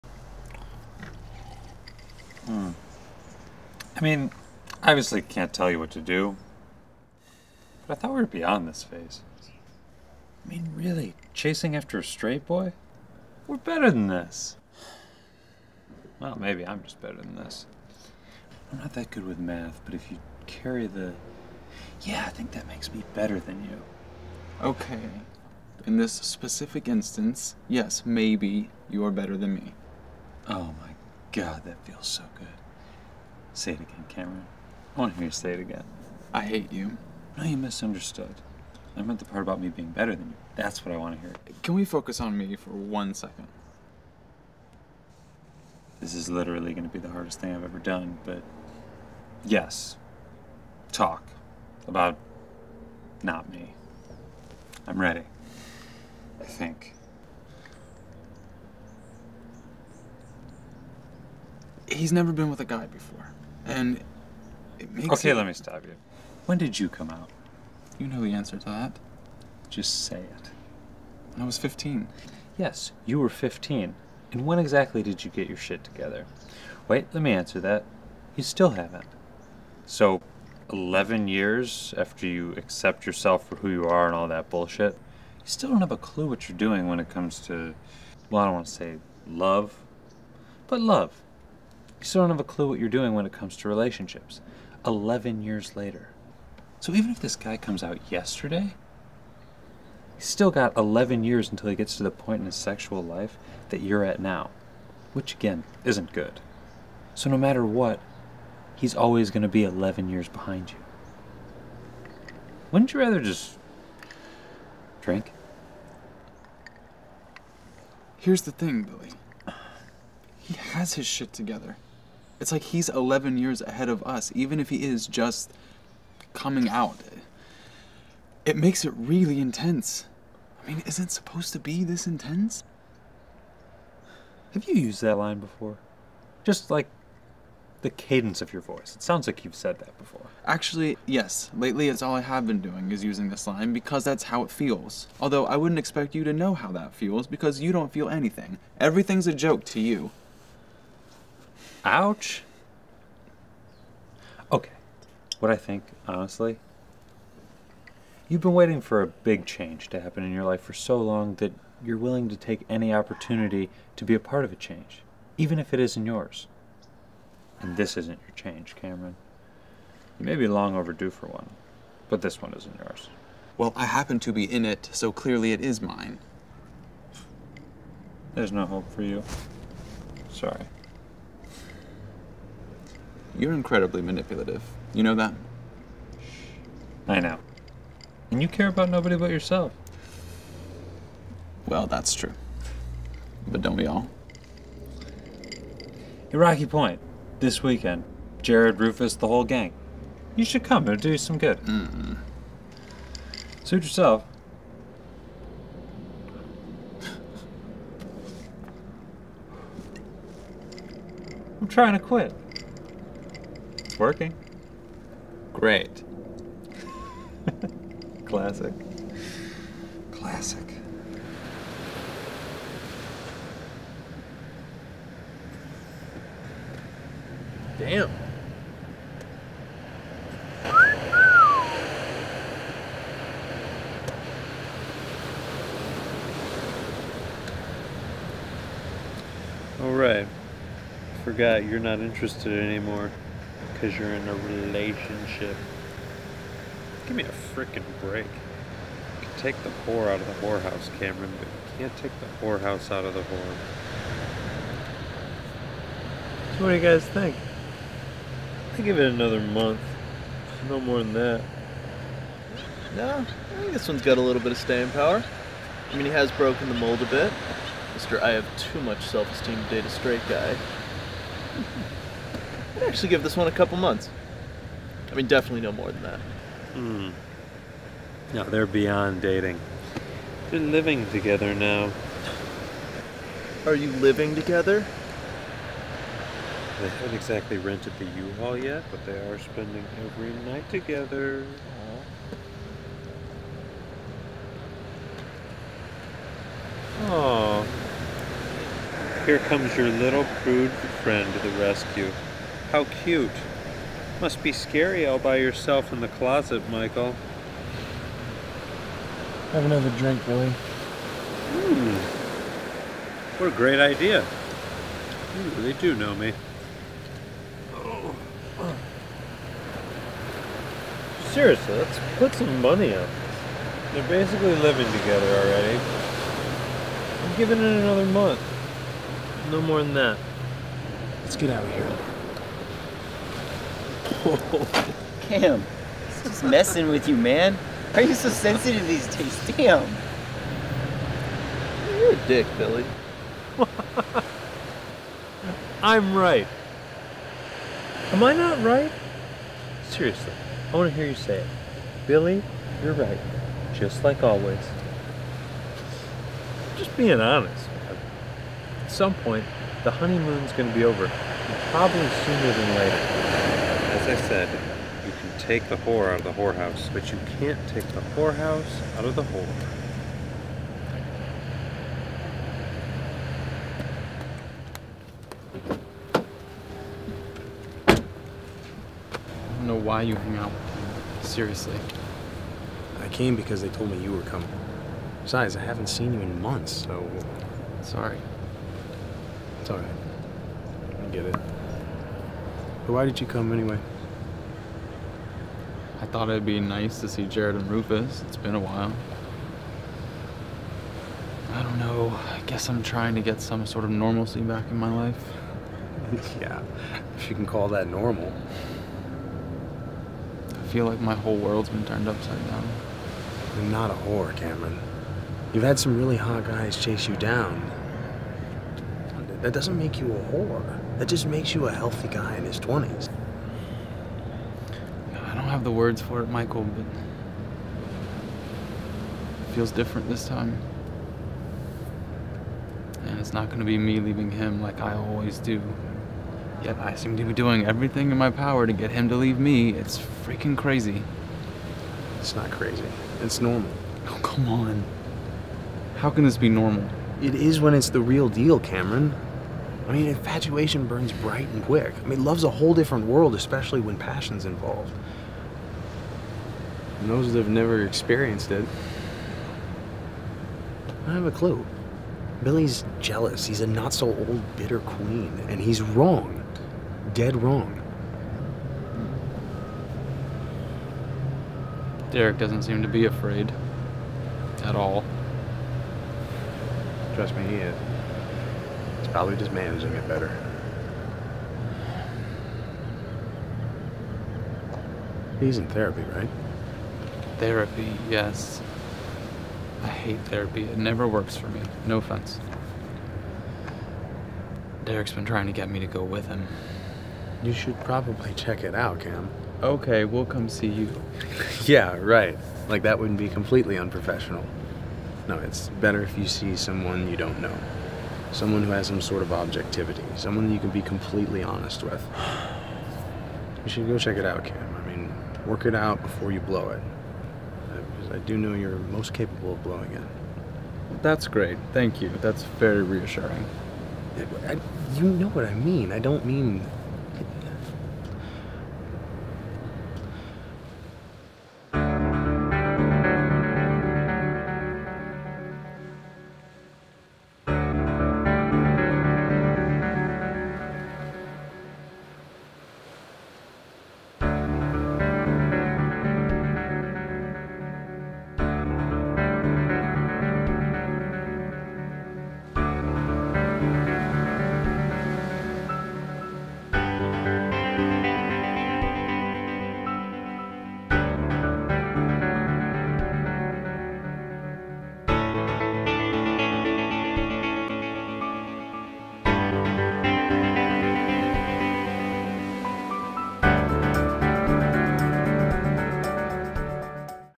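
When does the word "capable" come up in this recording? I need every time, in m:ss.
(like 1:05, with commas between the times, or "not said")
8:39.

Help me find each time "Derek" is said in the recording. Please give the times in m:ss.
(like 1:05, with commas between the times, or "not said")
7:52, 8:14.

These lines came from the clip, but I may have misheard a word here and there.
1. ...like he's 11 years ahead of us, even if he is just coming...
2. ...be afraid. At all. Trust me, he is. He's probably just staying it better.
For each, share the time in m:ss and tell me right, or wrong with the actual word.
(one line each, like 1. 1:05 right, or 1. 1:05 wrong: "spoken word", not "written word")
1. 2:02 right
2. 7:52 wrong: "managing", not "staying".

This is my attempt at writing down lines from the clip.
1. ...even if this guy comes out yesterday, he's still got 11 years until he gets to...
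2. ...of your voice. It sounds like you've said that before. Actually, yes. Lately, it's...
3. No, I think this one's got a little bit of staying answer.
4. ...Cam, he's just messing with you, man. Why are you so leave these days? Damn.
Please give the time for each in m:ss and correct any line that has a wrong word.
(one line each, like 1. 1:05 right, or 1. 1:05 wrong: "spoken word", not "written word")
1. 1:36 right
2. 2:18 right
3. 4:22 wrong: "power", not "answer"
4. 5:35 wrong: "sensitive", not "leave".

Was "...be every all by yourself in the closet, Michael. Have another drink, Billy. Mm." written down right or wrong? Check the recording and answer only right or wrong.
wrong.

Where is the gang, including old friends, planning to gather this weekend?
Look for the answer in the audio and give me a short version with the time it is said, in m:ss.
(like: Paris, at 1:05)
Rocky Point, at 3:16.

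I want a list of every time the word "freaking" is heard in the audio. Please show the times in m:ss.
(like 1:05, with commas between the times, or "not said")
4:07, 7:20.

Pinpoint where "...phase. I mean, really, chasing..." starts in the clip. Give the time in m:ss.
0:08.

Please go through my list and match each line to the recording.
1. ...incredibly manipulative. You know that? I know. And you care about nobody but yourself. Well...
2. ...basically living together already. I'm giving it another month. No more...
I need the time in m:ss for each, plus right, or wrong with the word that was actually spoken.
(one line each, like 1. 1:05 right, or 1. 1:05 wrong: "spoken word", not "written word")
1. 3:03 right
2. 5:24 right.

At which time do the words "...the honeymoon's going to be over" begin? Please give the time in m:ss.
5:59.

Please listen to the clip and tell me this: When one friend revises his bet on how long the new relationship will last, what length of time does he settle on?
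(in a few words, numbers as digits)
a couple months.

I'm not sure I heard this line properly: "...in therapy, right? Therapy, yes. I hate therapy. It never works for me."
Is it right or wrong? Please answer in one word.
right.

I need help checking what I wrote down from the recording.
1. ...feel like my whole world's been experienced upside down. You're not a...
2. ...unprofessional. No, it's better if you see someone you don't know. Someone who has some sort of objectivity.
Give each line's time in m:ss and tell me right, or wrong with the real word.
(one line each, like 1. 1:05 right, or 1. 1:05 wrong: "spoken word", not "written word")
1. 6:50 wrong: "turned", not "experienced"
2. 8:23 right.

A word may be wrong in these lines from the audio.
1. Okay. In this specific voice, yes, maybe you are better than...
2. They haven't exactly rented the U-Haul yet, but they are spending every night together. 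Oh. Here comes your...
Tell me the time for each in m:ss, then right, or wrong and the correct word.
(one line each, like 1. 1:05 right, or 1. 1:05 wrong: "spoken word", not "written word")
1. 0:24 wrong: "instance", not "voice"
2. 4:46 right.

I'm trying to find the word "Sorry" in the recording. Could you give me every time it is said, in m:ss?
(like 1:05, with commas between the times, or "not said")
3:00, 6:27.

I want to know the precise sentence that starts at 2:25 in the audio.
Although I wouldn't expect you to know how that feels because you don't feel anything.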